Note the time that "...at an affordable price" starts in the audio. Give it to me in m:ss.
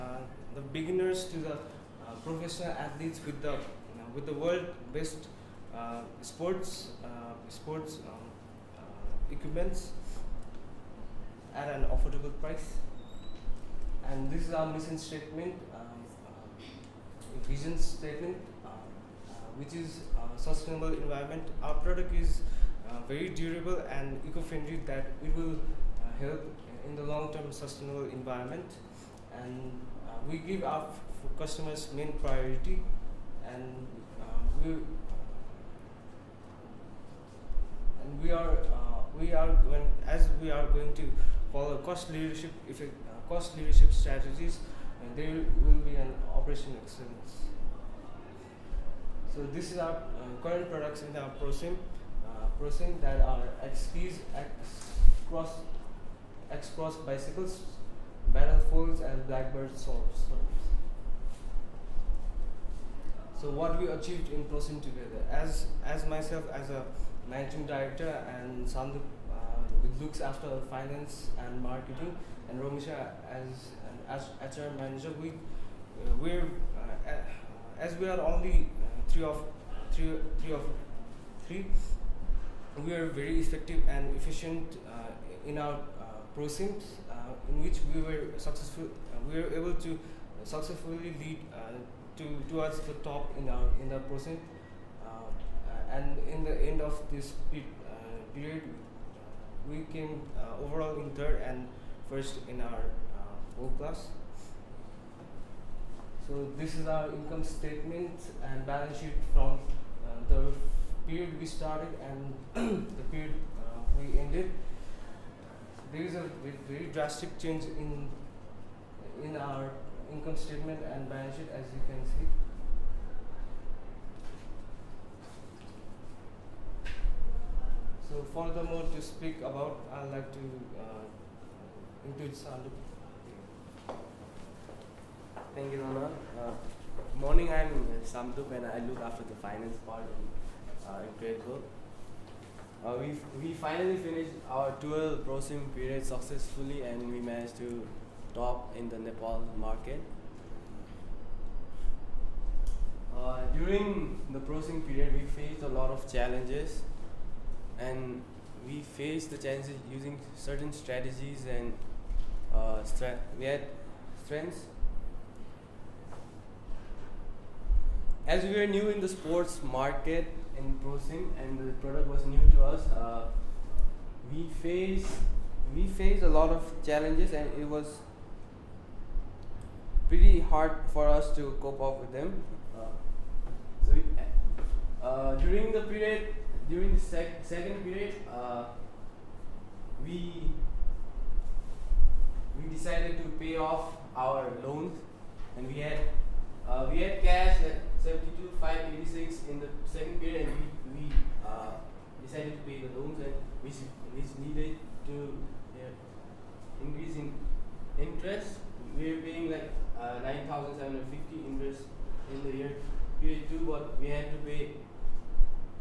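0:11.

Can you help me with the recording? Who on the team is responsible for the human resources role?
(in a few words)
Romisha.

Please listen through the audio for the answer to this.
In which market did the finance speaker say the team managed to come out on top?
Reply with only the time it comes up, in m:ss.
2:28.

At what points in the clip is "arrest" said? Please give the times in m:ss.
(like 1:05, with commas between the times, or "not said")
not said.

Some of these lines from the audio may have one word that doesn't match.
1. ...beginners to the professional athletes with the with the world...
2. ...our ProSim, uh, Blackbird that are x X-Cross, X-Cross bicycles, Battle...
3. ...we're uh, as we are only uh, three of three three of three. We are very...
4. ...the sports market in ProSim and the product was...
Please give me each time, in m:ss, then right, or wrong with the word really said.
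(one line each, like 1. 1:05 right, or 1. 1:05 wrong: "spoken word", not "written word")
1. 0:00 right
2. 0:51 wrong: "ProSim", not "Blackbird"
3. 1:16 right
4. 2:49 right.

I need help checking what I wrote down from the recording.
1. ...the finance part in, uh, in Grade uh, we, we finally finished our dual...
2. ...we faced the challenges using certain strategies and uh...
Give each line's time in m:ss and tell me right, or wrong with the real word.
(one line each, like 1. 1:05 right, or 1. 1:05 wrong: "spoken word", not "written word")
1. 2:19 right
2. 2:38 right.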